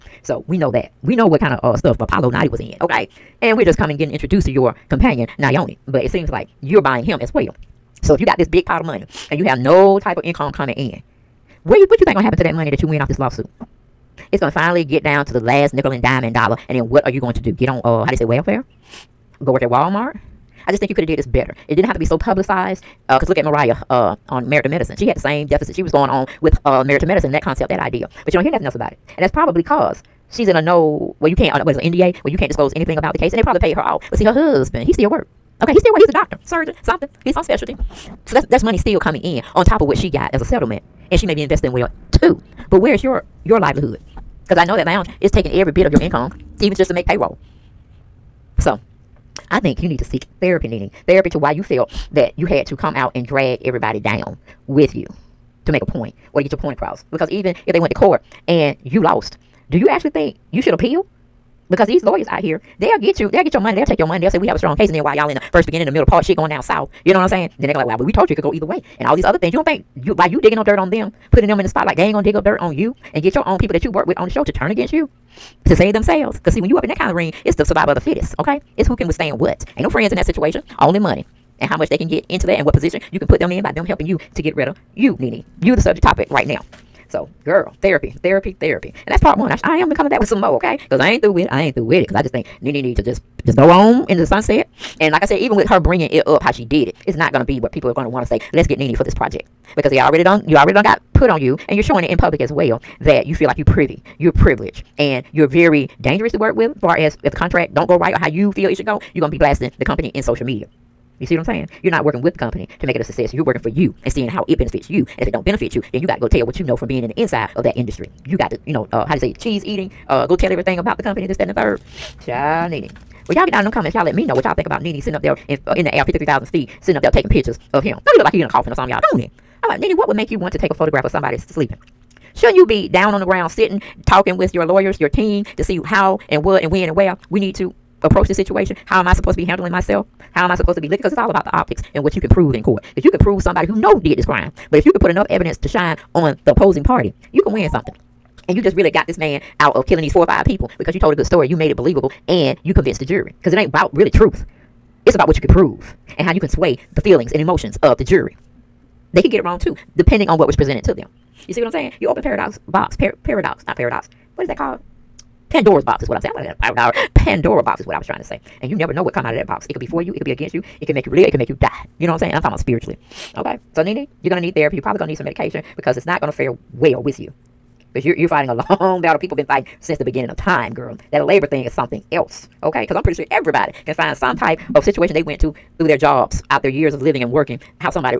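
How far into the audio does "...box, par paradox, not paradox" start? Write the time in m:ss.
2:42.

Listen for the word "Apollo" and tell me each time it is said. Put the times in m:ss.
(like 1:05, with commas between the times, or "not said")
0:02.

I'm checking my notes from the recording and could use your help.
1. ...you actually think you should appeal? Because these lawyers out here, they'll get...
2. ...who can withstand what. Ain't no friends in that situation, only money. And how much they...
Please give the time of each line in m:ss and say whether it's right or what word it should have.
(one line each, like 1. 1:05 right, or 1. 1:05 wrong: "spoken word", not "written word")
1. 0:59 right
2. 1:18 right.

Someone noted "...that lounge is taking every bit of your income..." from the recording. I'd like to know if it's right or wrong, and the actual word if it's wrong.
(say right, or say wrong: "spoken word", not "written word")
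right.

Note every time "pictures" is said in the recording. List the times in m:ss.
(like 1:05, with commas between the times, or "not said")
2:07.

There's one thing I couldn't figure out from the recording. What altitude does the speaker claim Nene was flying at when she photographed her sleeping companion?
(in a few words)
53,000 feet.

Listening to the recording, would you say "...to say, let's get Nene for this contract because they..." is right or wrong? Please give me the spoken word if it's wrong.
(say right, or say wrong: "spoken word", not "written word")
wrong: "project", not "contract".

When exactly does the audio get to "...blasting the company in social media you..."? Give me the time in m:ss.
1:49.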